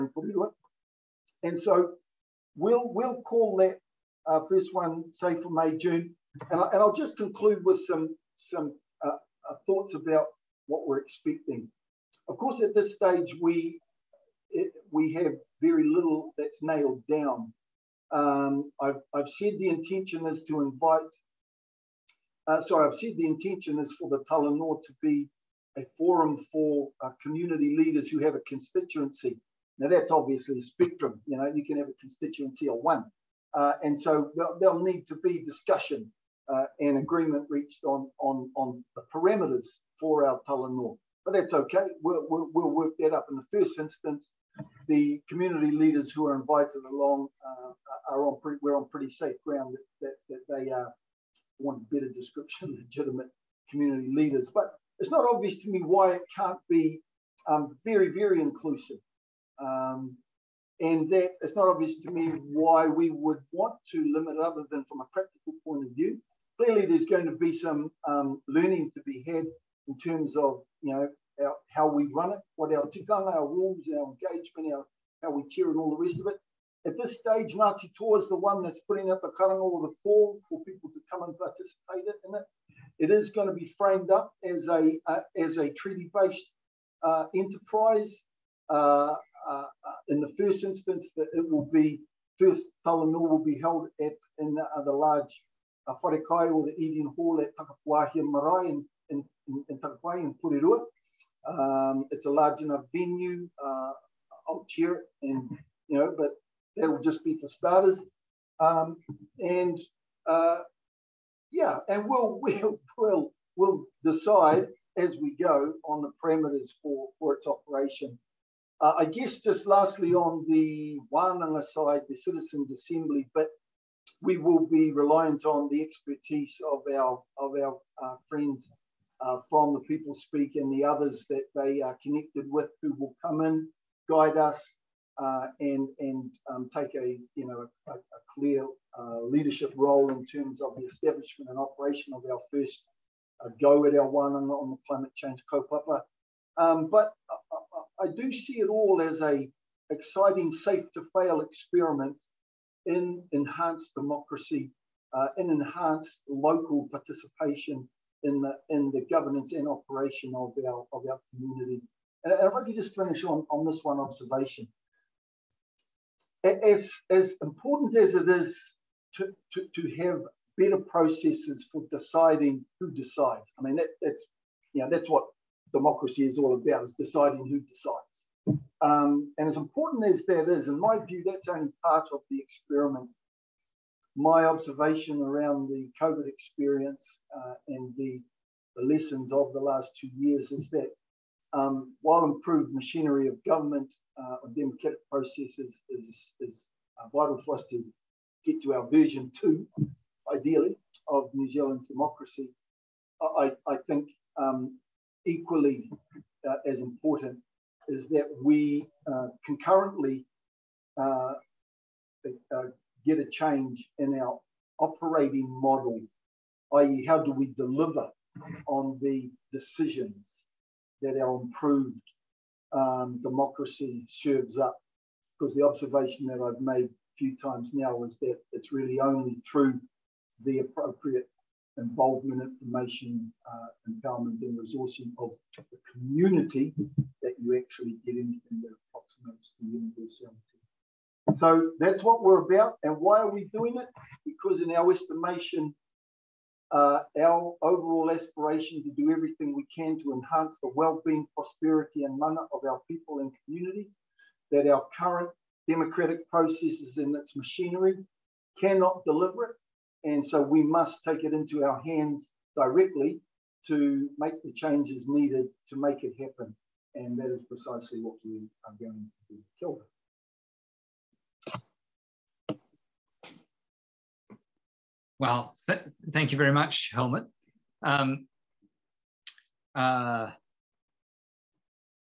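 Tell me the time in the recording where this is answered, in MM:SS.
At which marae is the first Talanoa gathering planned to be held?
01:37.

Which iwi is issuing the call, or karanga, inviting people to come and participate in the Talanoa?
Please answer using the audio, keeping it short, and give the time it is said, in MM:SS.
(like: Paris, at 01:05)
Ngāti Toa, at 01:17.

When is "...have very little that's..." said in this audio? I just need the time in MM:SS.
00:15.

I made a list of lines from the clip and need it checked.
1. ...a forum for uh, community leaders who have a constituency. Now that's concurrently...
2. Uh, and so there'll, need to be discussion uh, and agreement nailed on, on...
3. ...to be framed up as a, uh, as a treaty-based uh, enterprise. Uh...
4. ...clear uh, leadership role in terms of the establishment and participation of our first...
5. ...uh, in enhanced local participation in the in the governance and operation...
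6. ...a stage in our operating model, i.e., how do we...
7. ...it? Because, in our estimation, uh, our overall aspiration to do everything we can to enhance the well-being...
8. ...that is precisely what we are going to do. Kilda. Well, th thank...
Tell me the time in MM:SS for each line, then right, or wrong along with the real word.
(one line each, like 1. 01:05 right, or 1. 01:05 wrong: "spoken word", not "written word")
1. 00:25 wrong: "obviously", not "concurrently"
2. 00:33 wrong: "reached", not "nailed"
3. 01:23 right
4. 02:18 wrong: "operation", not "participation"
5. 02:35 right
6. 03:33 wrong: "change", not "stage"
7. 04:03 right
8. 04:27 right.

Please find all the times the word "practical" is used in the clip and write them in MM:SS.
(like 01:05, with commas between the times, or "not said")
01:05.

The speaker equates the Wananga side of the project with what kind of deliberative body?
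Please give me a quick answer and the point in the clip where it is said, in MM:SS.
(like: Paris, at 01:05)
Citizens Assembly, at 02:02.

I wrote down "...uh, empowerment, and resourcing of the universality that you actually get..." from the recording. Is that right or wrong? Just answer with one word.
wrong.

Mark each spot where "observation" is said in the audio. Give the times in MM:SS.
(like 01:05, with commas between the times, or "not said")
02:43, 03:04, 03:45.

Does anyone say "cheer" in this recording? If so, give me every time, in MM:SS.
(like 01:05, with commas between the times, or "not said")
01:15, 01:44.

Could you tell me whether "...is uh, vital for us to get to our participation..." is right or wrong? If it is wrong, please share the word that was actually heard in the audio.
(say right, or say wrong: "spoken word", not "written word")
wrong: "version", not "participation".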